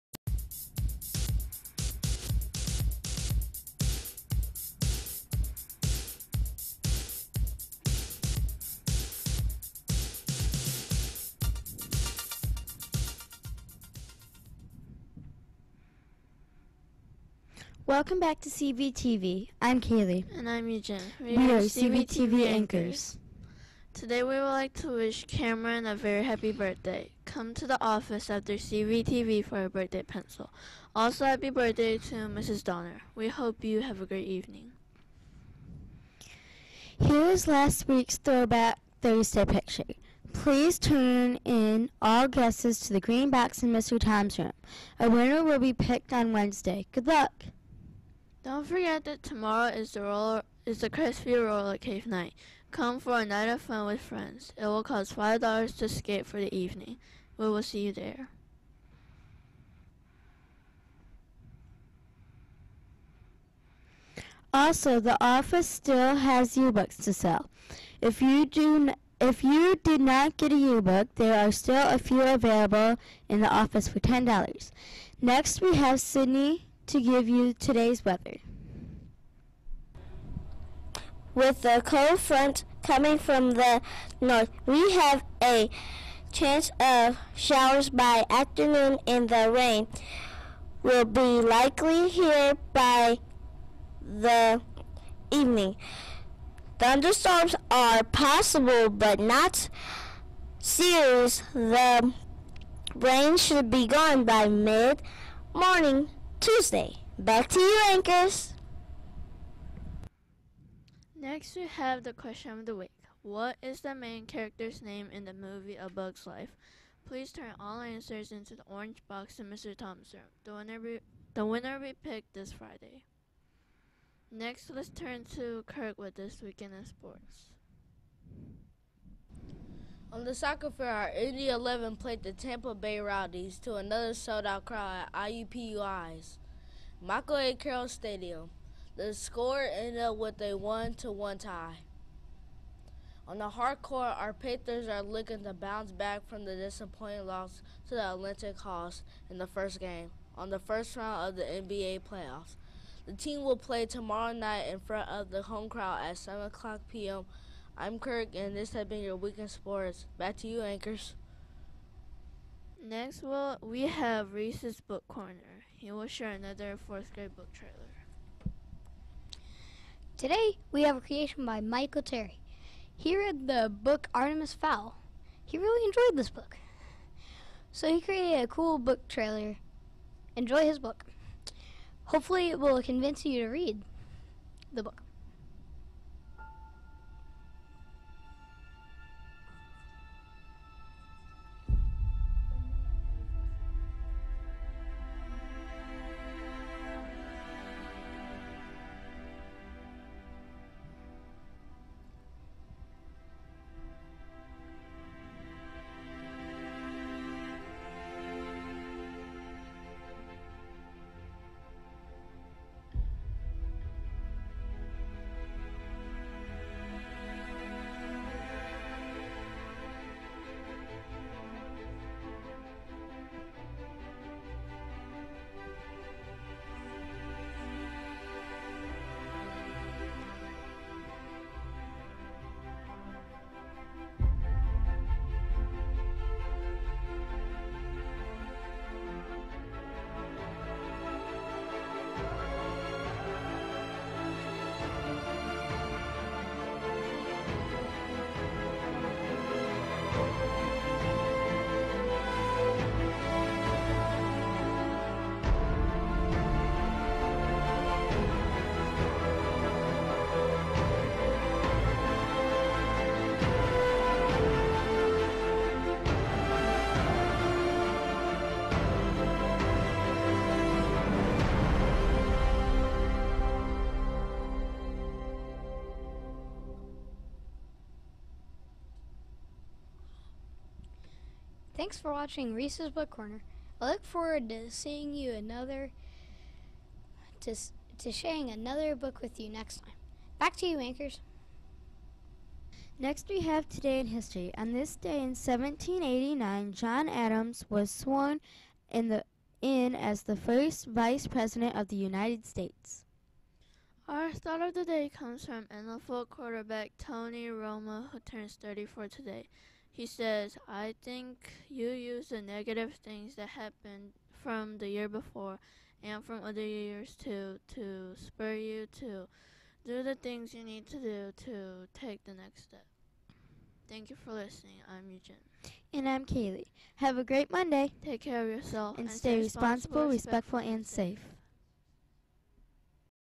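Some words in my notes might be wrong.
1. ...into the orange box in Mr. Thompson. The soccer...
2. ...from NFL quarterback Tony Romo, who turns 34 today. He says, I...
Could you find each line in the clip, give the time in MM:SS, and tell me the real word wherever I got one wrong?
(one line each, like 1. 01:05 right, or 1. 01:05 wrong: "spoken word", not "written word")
1. 01:58 wrong: "winner", not "soccer"
2. 05:05 right.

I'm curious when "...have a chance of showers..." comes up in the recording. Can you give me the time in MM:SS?
01:24.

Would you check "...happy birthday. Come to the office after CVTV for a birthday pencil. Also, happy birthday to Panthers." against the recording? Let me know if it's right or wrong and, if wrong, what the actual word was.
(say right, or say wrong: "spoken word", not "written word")
wrong: "Mrs", not "Panthers".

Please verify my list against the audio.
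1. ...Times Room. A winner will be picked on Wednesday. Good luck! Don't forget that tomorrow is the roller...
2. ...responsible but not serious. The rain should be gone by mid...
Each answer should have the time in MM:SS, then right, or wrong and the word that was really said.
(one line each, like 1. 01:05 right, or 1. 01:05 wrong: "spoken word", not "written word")
1. 00:43 right
2. 01:38 wrong: "possible", not "responsible".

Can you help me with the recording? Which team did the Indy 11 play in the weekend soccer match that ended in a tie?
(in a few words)
Tampa Bay Rowdies.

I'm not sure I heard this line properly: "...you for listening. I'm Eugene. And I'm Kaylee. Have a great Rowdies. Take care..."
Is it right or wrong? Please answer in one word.
wrong.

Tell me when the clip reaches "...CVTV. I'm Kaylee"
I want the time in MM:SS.
00:18.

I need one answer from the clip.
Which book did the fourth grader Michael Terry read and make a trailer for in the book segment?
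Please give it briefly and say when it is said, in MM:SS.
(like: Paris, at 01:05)
Artemis Fowl, at 02:54.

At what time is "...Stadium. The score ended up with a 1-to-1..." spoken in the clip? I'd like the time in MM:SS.
02:17.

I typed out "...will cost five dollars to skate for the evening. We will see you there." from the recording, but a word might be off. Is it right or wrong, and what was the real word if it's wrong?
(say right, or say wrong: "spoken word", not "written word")
right.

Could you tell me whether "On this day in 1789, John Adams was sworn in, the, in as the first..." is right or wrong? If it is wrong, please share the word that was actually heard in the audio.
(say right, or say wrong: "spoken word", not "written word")
right.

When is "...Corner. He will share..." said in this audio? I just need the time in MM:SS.
02:45.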